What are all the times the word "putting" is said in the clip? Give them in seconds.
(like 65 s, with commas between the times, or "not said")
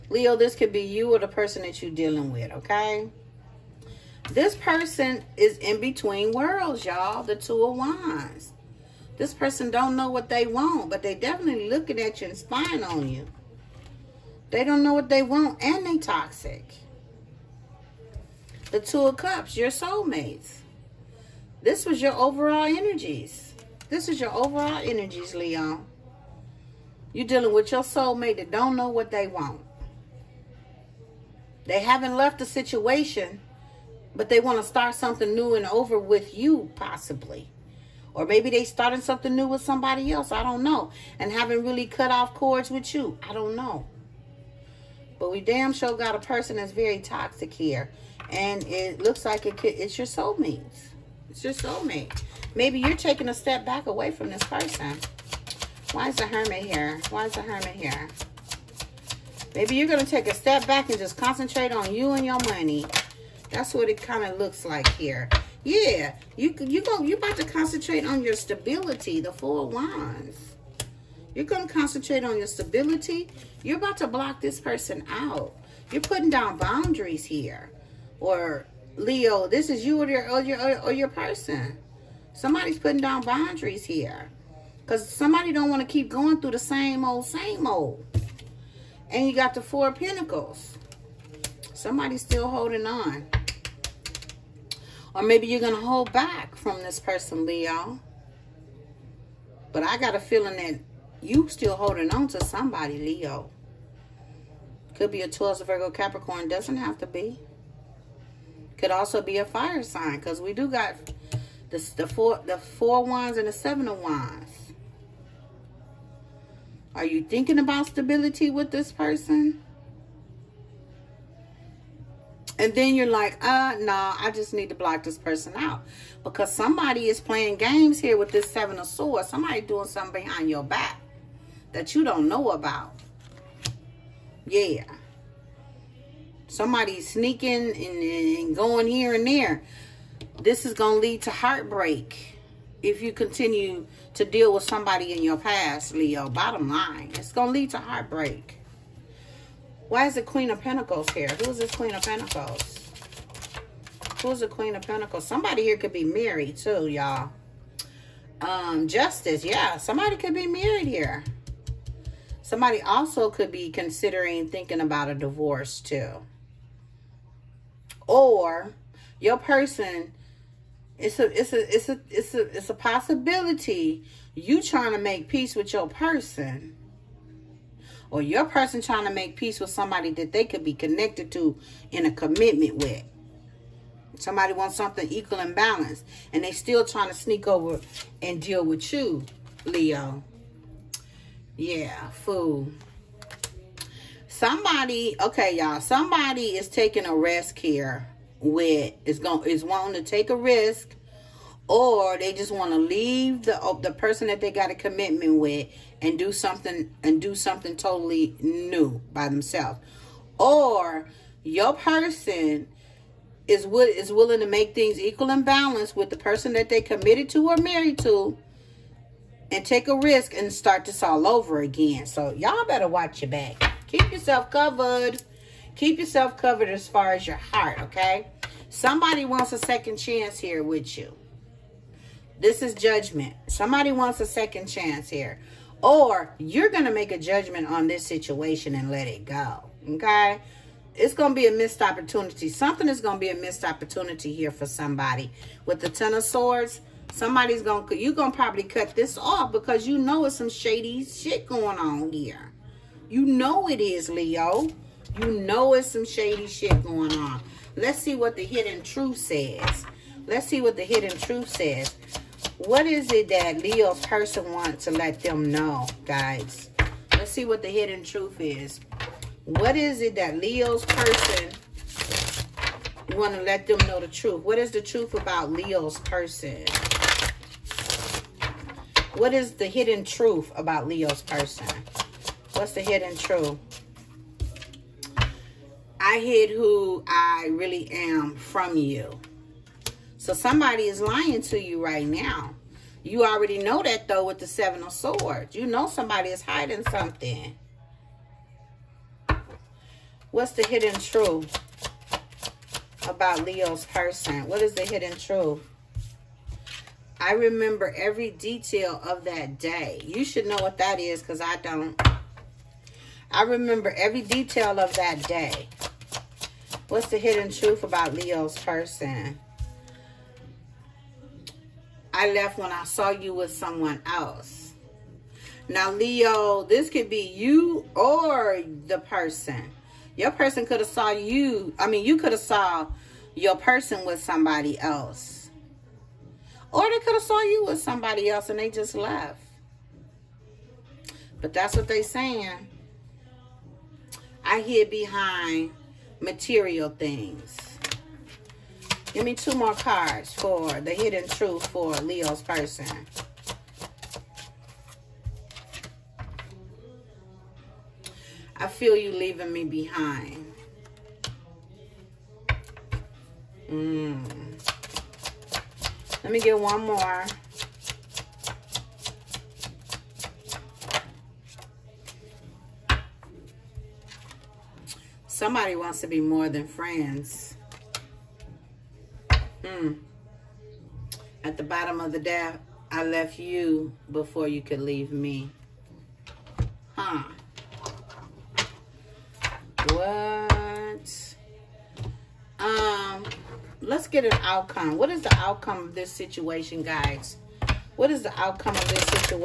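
76 s, 82 s.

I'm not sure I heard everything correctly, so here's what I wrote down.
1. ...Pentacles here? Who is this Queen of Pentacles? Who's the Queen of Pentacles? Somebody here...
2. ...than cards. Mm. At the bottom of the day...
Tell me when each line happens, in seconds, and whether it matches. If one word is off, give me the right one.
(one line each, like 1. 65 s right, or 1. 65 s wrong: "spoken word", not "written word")
1. 150 s right
2. 376 s wrong: "friends", not "cards".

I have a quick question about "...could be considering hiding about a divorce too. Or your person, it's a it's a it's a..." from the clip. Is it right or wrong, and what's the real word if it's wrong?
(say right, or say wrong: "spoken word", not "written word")
wrong: "thinking", not "hiding".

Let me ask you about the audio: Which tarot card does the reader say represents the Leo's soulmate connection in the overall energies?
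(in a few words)
Two of Cups.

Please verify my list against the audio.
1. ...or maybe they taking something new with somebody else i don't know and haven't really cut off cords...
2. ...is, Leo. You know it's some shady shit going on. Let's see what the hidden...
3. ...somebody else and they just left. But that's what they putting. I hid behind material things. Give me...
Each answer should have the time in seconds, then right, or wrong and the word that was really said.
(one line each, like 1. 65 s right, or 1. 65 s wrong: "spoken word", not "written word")
1. 38 s wrong: "starting", not "taking"
2. 253 s right
3. 337 s wrong: "saying", not "putting".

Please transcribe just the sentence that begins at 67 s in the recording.
You about to concentrate on your stability.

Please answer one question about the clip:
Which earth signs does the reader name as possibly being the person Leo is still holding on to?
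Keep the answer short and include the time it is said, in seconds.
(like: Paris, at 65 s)
Taurus, Virgo, Capricorn, at 105 s.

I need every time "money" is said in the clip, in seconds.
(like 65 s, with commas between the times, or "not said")
62 s.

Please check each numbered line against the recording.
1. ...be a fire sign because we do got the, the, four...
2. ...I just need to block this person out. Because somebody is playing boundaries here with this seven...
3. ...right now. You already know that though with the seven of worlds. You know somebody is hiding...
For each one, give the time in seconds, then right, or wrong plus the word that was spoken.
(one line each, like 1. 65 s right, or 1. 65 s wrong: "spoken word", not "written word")
1. 109 s right
2. 124 s wrong: "games", not "boundaries"
3. 291 s wrong: "swords", not "worlds".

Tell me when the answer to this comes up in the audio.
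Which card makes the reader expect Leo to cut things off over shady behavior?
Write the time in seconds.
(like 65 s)
245 s.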